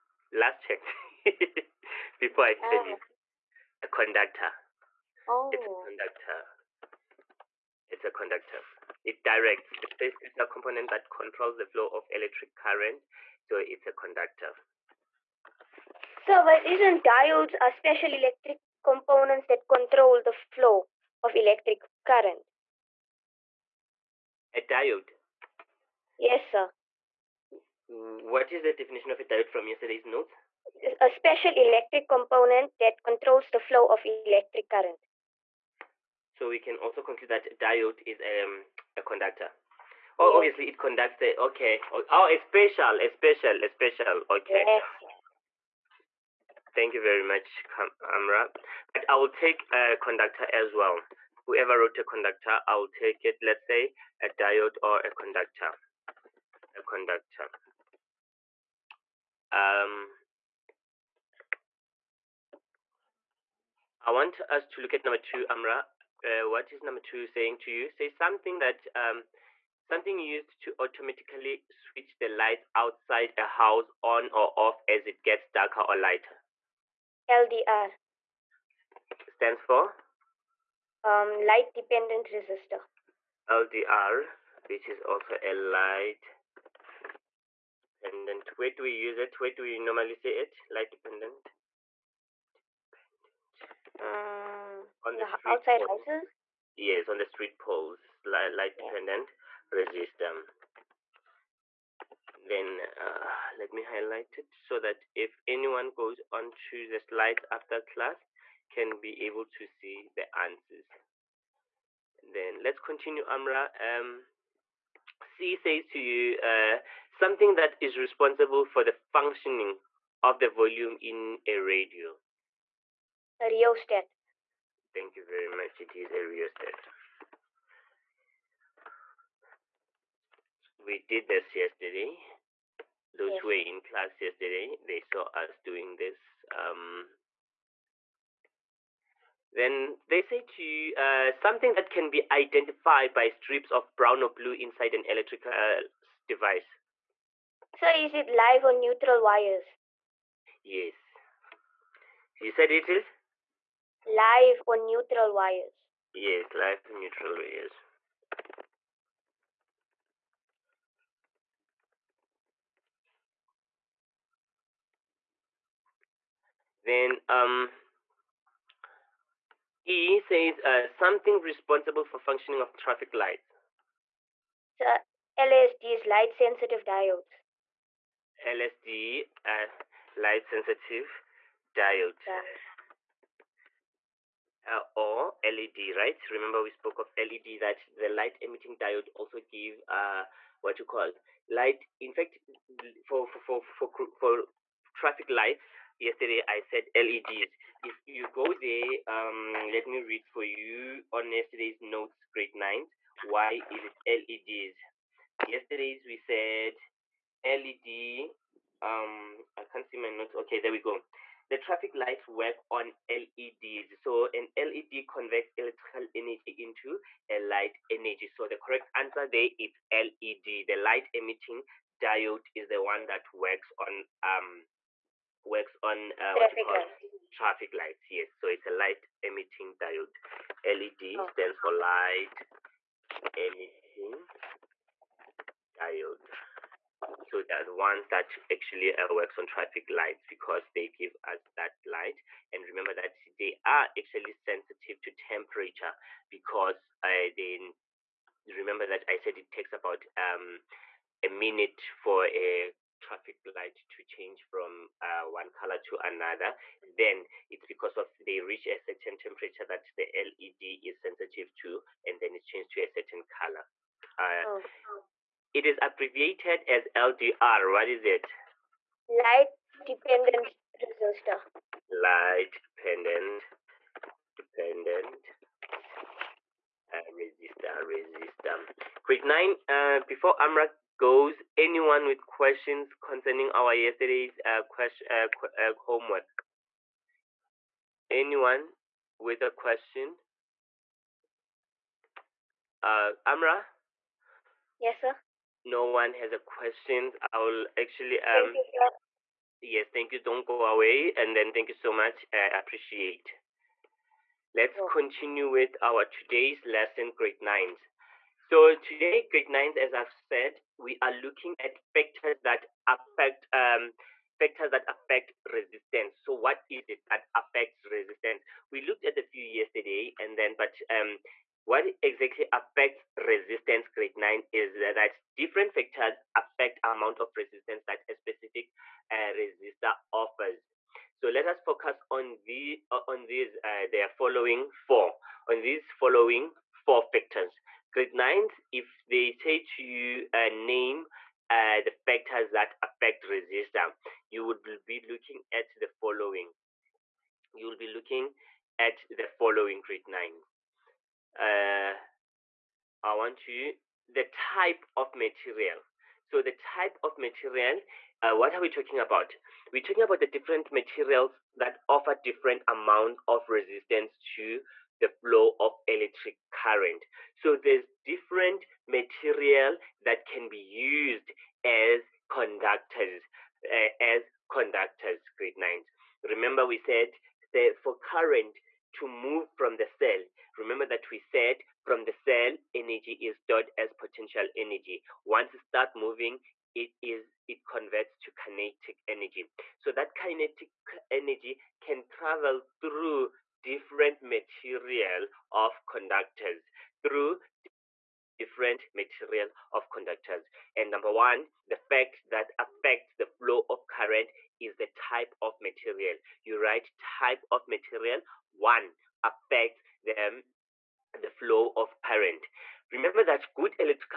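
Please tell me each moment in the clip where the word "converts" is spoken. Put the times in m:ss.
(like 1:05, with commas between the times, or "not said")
3:35, 6:27.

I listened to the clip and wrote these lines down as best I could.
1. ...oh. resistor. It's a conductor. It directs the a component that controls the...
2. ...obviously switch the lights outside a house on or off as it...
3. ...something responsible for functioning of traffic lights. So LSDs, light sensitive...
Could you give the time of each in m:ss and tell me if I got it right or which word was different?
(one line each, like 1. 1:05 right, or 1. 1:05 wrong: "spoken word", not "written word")
1. 0:05 wrong: "conductor", not "resistor"
2. 1:10 wrong: "automatically", not "obviously"
3. 2:50 right.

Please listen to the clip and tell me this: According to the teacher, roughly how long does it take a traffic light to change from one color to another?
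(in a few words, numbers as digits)
A minute.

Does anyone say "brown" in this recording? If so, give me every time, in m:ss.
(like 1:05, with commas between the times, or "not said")
2:23.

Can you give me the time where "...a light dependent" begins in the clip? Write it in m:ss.
1:25.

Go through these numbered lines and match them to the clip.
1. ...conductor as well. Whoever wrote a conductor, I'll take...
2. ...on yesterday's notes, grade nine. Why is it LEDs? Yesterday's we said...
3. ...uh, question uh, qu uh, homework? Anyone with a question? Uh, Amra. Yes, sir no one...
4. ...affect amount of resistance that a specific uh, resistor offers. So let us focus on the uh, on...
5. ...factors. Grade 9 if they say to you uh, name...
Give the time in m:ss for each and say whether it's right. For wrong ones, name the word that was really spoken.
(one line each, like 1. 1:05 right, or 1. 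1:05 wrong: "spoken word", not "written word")
1. 0:49 right
2. 3:21 right
3. 4:44 right
4. 5:26 right
5. 5:37 right.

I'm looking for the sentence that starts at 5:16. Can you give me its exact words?
So what is it that affects resistance?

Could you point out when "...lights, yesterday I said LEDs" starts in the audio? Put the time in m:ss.
3:15.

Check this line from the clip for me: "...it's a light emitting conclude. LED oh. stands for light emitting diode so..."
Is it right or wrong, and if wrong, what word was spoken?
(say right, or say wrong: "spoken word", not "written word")
wrong: "diode", not "conclude".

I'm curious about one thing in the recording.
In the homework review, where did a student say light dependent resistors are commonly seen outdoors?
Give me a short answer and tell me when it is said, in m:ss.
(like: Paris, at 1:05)
Street poles, at 1:37.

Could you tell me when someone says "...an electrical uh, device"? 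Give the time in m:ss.
2:24.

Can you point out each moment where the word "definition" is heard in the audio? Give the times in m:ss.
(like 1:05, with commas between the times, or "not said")
0:28.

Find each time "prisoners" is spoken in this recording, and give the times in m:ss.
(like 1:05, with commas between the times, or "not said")
not said.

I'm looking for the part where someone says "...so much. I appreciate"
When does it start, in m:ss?
5:01.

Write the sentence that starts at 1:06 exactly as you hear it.
Uh, what is number two saying to you?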